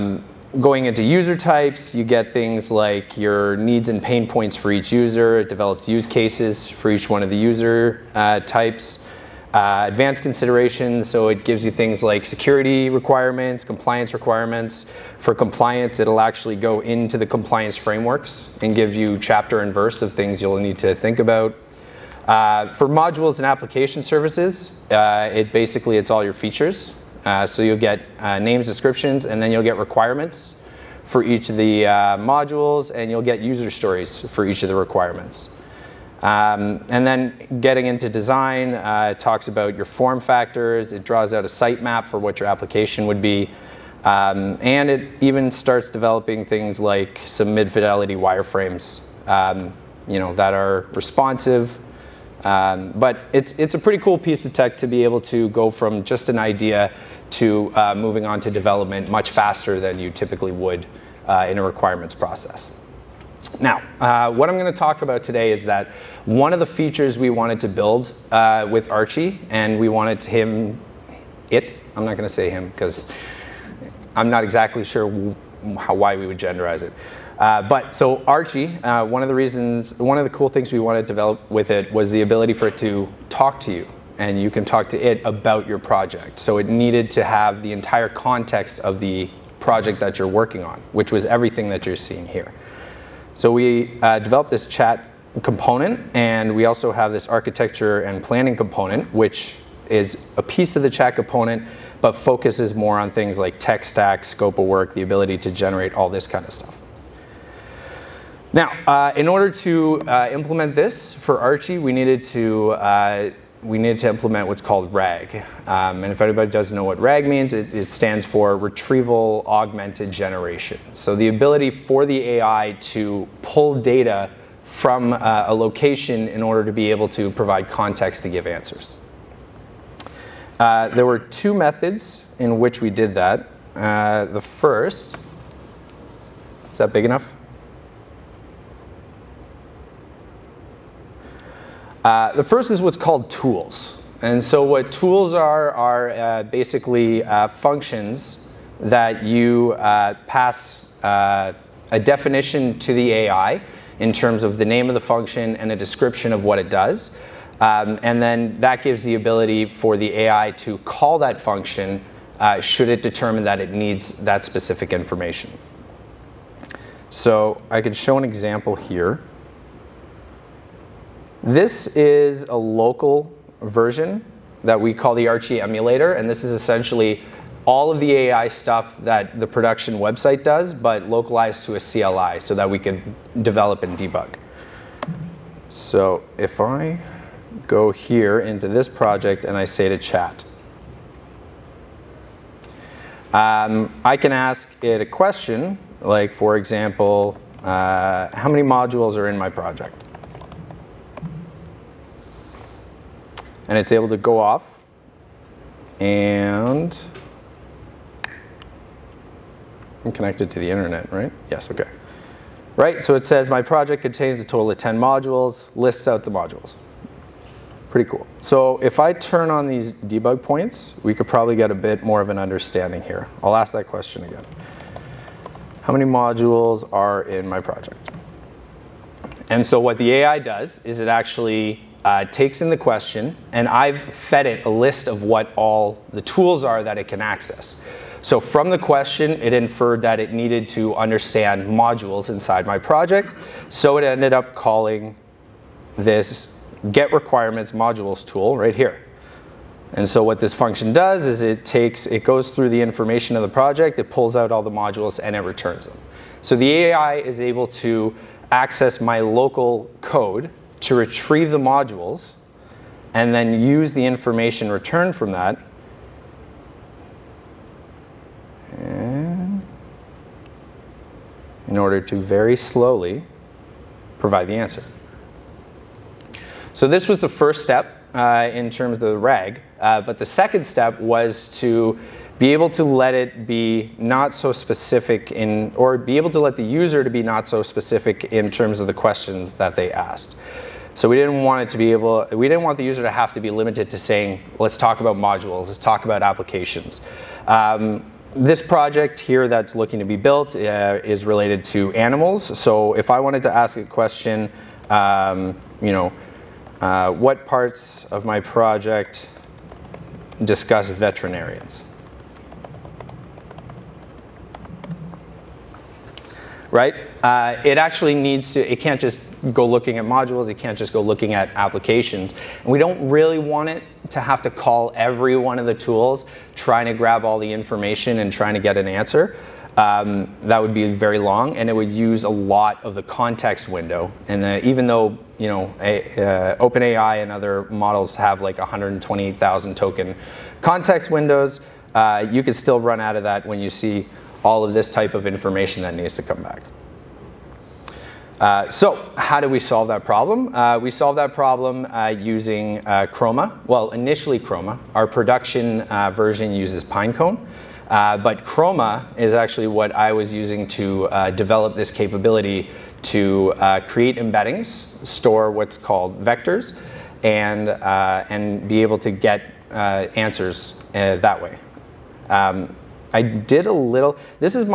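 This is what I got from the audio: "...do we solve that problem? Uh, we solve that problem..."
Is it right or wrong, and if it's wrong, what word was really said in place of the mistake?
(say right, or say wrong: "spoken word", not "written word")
right.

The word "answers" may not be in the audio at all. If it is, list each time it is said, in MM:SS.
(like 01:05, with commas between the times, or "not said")
02:08, 04:34, 05:28, 06:09.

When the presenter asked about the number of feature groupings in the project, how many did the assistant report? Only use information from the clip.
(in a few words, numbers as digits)
10.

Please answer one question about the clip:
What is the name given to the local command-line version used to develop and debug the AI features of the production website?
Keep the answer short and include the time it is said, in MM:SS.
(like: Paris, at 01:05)
Archie emulator, at 02:55.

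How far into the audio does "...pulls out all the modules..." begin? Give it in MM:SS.
04:14.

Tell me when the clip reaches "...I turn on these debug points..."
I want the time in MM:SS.
03:38.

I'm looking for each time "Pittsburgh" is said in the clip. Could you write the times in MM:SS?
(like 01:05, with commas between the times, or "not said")
not said.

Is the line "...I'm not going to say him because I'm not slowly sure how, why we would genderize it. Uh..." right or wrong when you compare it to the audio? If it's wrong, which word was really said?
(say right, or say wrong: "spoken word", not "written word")
wrong: "exactly", not "slowly".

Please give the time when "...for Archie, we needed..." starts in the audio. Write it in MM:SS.
01:51.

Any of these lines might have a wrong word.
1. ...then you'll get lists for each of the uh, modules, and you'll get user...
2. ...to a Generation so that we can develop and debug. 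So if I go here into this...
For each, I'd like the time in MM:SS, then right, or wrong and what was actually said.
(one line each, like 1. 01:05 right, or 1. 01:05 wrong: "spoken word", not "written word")
1. 00:29 wrong: "requirements", not "lists"
2. 03:01 wrong: "CLI", not "Generation".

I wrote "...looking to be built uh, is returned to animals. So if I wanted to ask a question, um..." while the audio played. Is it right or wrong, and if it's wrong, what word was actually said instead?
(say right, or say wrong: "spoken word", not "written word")
wrong: "related", not "returned".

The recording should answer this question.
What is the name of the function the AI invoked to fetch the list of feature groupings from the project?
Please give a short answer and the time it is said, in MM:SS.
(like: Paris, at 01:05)
get requirements modules, at 04:06.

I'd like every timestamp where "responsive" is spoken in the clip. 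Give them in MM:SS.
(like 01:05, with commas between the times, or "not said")
00:50.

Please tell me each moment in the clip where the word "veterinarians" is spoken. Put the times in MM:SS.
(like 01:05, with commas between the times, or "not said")
05:10.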